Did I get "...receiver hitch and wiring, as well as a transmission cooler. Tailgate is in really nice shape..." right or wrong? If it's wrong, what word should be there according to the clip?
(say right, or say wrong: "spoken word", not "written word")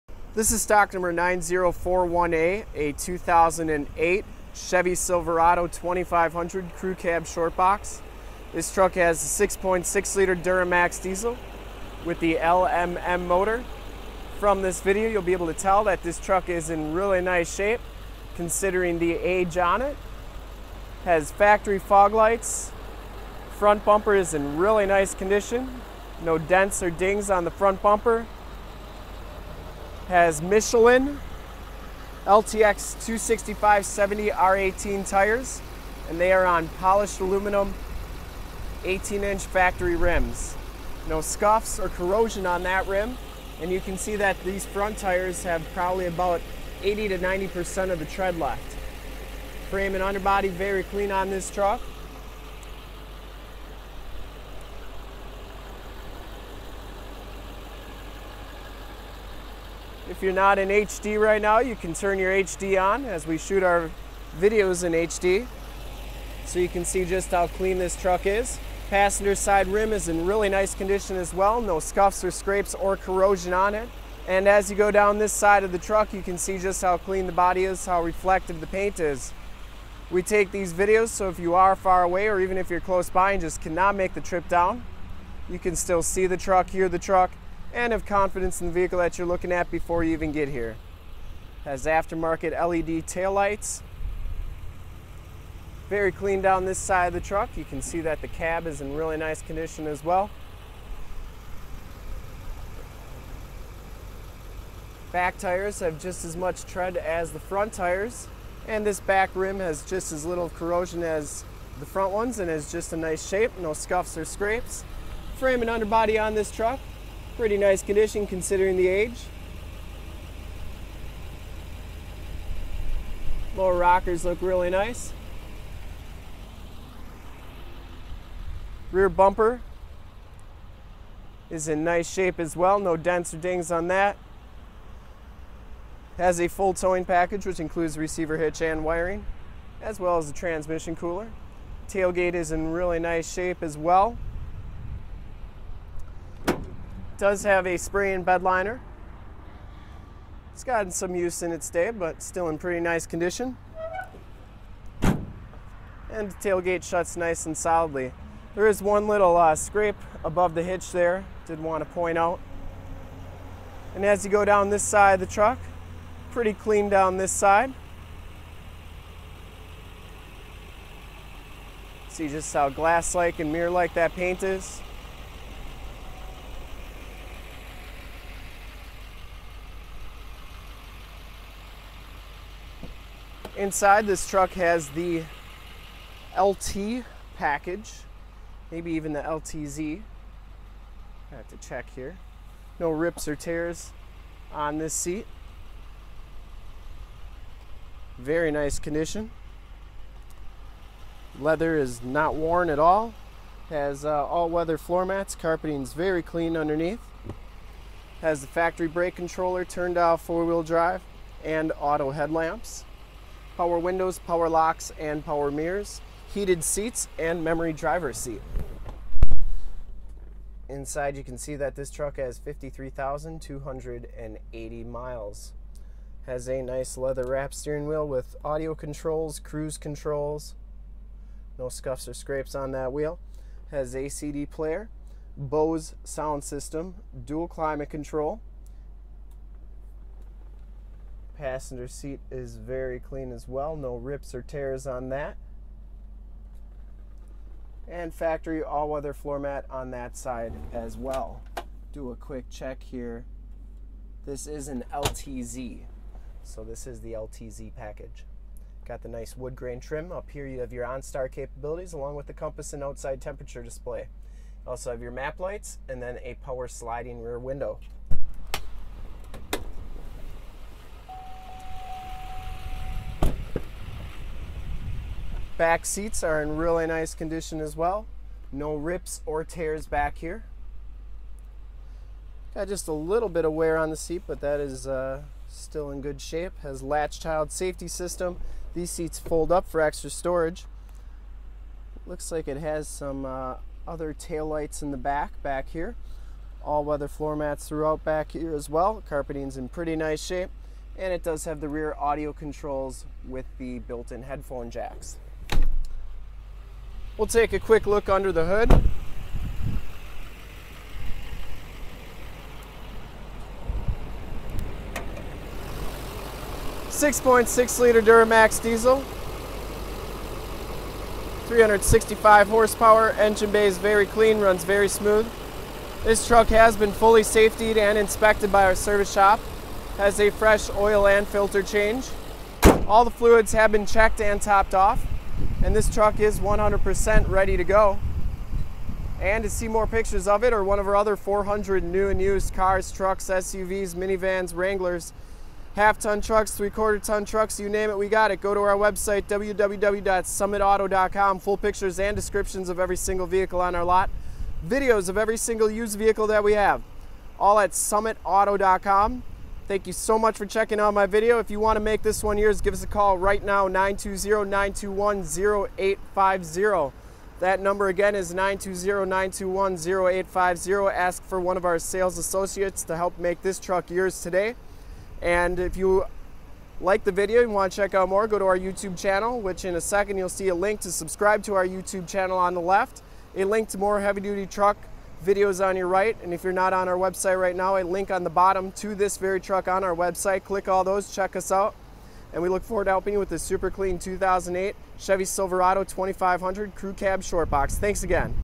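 right.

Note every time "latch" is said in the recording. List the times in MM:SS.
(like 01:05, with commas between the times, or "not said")
04:46.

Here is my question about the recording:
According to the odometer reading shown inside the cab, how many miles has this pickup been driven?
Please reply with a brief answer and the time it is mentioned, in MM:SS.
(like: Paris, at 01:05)
53,280, at 03:42.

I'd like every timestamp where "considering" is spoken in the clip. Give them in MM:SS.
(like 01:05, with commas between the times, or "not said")
00:18, 01:58.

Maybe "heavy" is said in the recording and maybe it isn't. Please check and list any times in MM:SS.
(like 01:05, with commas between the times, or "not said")
06:24.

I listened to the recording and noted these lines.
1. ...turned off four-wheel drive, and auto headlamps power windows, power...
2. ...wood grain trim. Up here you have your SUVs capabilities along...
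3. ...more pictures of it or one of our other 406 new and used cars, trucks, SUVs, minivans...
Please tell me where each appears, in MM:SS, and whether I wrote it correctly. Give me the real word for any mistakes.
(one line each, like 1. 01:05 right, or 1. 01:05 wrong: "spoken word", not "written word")
1. 03:29 right
2. 04:19 wrong: "OnStar", not "SUVs"
3. 05:39 wrong: "400", not "406".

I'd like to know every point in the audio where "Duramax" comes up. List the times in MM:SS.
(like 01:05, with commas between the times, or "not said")
00:10, 05:18.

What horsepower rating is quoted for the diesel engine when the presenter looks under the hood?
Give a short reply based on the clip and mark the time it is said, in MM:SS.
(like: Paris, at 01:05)
365, at 05:21.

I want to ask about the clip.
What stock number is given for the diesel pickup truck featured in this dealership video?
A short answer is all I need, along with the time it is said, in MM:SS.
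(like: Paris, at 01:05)
9041A, at 00:01.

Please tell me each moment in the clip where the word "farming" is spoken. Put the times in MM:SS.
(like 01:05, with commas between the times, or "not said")
not said.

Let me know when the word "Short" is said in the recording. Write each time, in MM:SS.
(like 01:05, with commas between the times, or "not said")
00:07, 06:37.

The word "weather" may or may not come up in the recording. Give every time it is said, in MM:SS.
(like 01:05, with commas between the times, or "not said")
03:24, 04:08, 04:56.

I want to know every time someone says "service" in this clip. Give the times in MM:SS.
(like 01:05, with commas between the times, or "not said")
05:28.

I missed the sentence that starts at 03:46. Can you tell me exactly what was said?
Has a nice leather wrap steering wheel with audio controls, cruise controls, no scuffs or scrapes on that wheel.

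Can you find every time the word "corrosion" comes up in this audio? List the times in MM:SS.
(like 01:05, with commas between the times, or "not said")
00:41, 01:12, 01:50.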